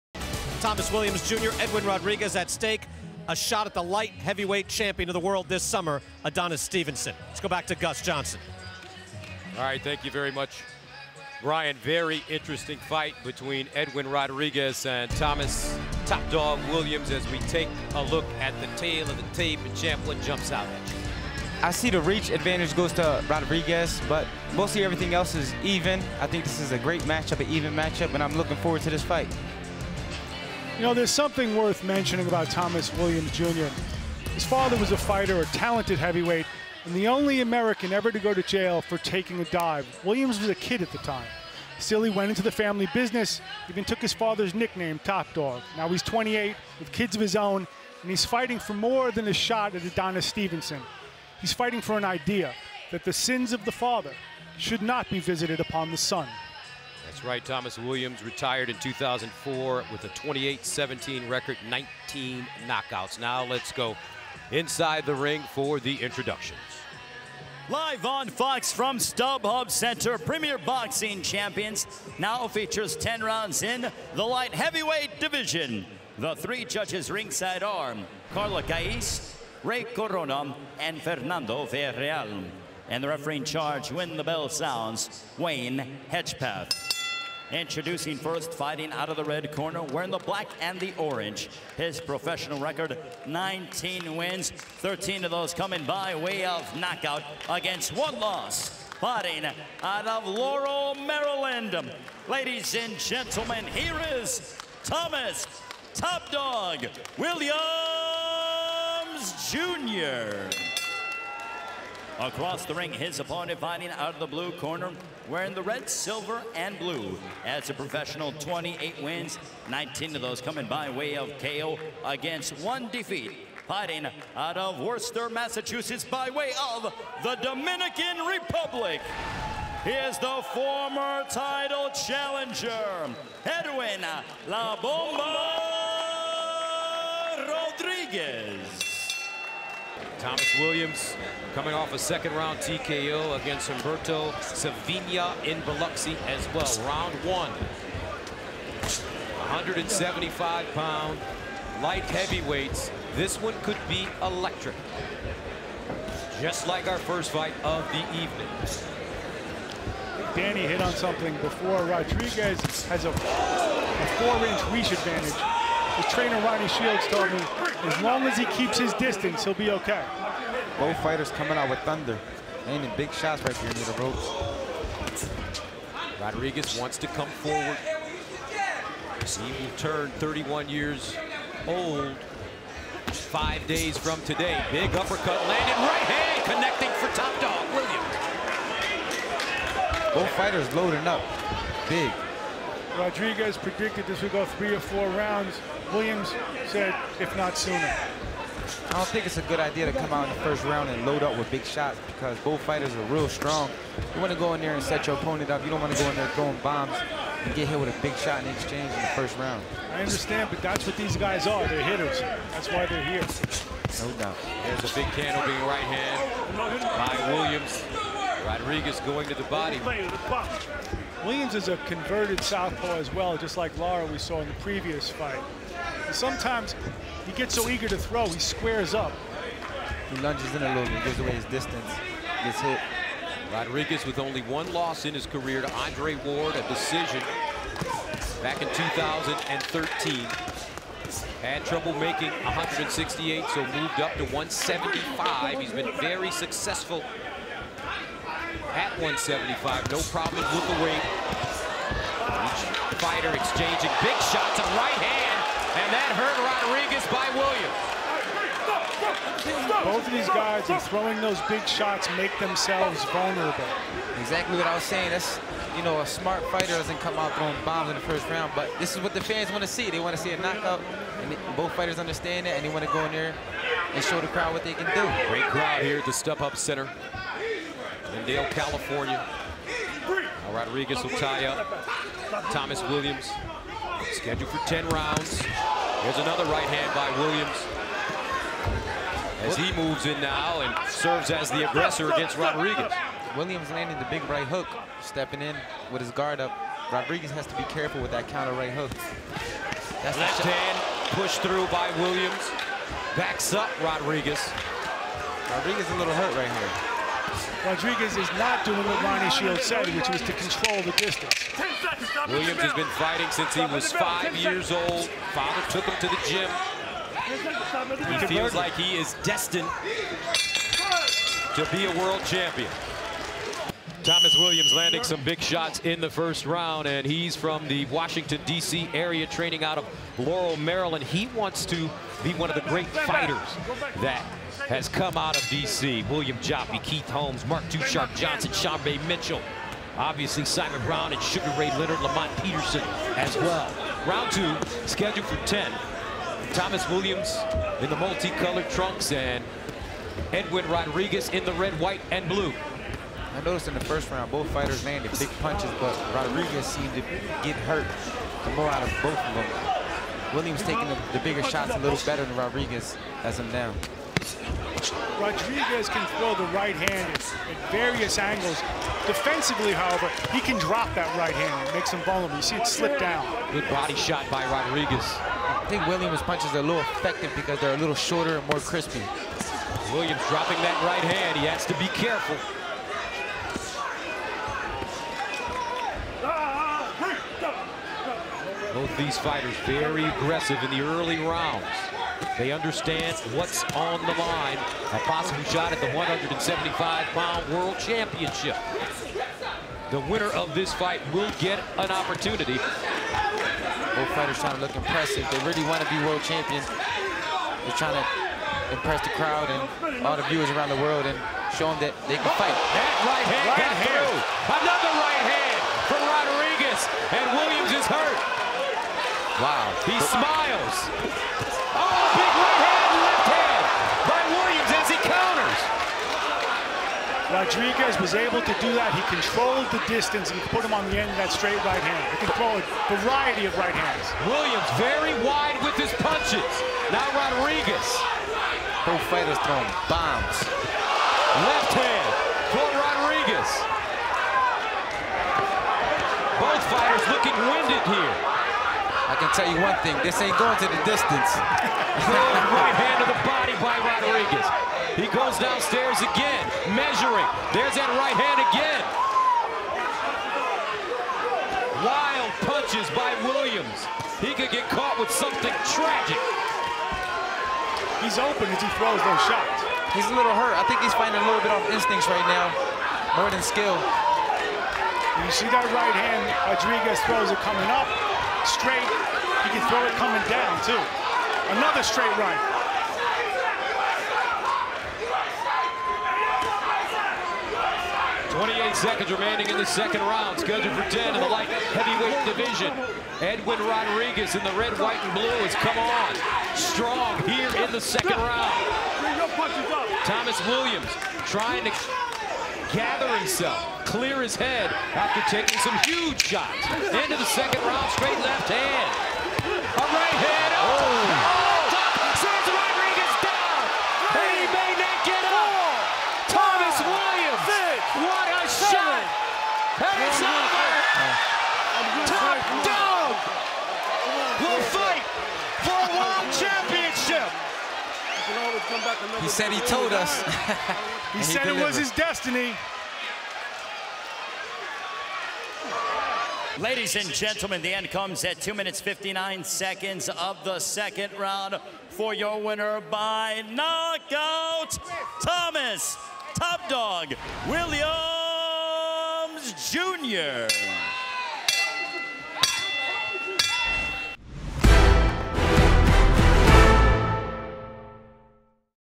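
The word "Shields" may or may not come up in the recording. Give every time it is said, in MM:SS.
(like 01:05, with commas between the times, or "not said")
02:46, 05:09.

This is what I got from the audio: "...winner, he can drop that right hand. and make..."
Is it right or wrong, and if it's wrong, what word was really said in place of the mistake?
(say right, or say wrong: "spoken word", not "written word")
wrong: "however", not "winner".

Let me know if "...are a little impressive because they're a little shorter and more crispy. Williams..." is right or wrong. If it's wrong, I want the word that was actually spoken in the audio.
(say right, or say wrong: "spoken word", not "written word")
wrong: "effective", not "impressive".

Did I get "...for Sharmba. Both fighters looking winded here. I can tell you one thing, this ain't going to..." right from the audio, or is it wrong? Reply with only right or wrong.
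wrong.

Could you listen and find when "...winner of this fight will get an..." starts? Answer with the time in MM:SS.
06:40.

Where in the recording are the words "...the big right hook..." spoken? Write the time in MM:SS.
04:53.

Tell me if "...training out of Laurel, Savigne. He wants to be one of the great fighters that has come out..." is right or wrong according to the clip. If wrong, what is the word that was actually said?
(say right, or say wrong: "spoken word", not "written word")
wrong: "Maryland", not "Savigne".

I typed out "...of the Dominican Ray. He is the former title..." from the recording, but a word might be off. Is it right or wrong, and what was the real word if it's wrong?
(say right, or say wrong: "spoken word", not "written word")
wrong: "Republic", not "Ray".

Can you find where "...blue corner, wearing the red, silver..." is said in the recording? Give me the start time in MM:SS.
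01:54.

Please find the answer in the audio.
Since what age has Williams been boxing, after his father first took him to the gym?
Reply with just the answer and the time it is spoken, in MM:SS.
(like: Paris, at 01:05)
5, at 05:13.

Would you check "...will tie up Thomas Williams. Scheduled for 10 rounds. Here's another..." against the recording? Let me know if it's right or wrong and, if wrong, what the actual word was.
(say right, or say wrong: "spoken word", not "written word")
right.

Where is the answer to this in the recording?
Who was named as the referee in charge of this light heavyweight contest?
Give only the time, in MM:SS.
01:25.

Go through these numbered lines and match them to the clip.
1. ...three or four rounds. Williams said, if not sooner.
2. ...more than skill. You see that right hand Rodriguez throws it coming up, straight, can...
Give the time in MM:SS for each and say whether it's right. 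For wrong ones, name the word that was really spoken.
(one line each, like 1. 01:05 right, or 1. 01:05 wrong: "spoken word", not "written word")
1. 03:14 right
2. 07:53 right.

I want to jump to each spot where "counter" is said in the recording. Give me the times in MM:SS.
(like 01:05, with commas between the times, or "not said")
04:58, 07:05.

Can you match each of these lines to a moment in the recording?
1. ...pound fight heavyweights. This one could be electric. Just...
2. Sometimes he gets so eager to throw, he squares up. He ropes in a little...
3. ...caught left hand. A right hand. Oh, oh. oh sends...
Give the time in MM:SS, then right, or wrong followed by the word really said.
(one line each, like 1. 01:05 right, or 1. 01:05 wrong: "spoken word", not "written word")
1. 02:30 wrong: "light", not "fight"
2. 03:46 wrong: "lunges", not "ropes"
3. 08:27 wrong: "straight", not "caught".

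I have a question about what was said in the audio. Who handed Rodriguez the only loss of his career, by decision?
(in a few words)
Andre Ward.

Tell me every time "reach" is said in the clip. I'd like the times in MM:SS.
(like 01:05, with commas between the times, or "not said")
00:22, 02:44.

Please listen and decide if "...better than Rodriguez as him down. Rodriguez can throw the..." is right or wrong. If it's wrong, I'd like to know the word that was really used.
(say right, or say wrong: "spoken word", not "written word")
right.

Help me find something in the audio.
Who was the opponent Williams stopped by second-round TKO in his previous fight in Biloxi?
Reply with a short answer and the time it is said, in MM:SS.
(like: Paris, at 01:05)
Humberto Savigne, at 02:23.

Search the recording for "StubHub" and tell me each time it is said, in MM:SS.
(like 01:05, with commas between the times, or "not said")
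01:08, 04:36.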